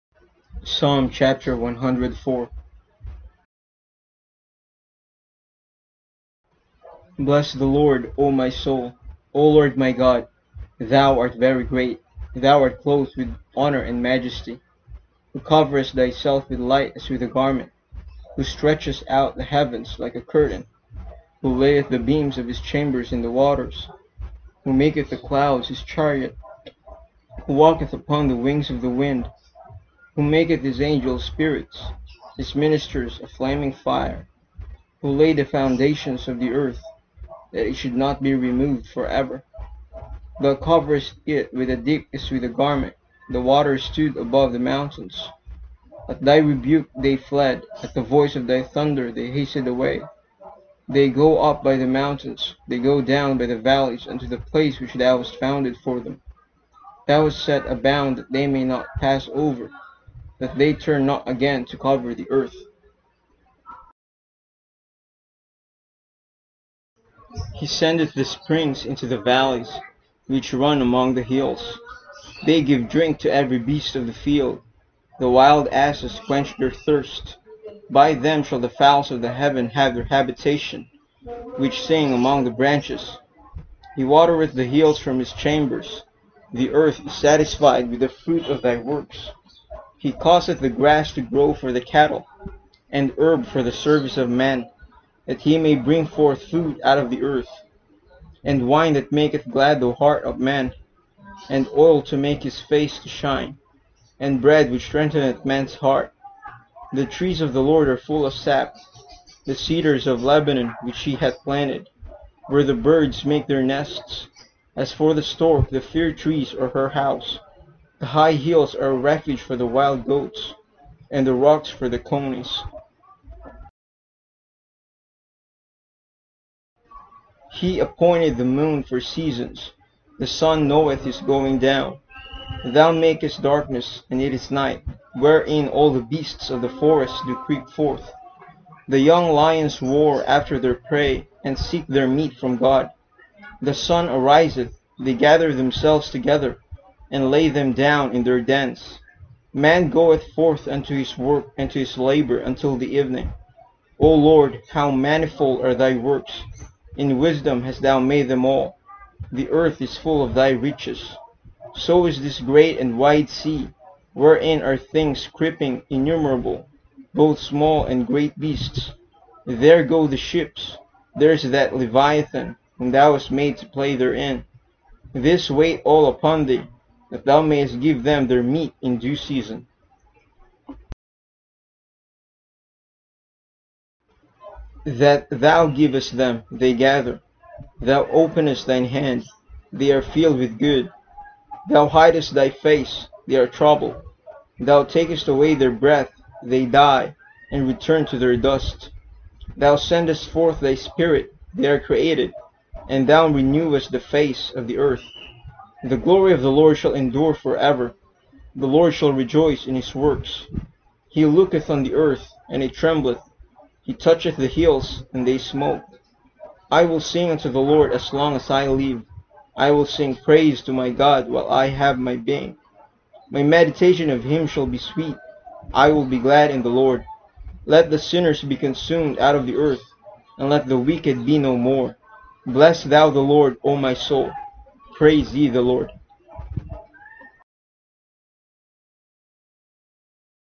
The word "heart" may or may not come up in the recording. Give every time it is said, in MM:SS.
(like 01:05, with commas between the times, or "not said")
01:39, 01:45.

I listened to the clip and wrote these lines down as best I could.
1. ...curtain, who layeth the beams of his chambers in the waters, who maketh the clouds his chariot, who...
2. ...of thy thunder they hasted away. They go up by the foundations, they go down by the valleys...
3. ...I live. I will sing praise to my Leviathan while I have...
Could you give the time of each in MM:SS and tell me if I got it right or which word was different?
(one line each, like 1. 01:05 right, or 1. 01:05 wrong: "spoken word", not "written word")
1. 00:20 right
2. 00:48 wrong: "mountains", not "foundations"
3. 03:38 wrong: "God", not "Leviathan".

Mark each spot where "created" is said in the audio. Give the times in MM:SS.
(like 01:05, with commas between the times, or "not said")
03:21.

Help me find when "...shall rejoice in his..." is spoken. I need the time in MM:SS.
03:28.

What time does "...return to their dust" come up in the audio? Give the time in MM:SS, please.
03:17.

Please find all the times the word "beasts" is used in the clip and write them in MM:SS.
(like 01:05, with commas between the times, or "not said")
01:13, 02:16, 02:48.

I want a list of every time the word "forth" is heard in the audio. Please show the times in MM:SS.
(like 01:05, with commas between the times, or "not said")
01:36, 02:17, 02:30, 03:20.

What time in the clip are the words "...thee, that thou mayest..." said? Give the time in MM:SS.
02:56.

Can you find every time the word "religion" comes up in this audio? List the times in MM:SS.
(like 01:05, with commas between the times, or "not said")
not said.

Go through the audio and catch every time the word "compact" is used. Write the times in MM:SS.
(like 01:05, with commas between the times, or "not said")
not said.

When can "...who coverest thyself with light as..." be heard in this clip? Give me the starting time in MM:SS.
00:15.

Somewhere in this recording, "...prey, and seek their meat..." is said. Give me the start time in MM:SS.
02:20.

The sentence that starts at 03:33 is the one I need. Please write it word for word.
He toucheth the hills, and they smoke.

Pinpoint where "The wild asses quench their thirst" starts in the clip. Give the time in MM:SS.
01:15.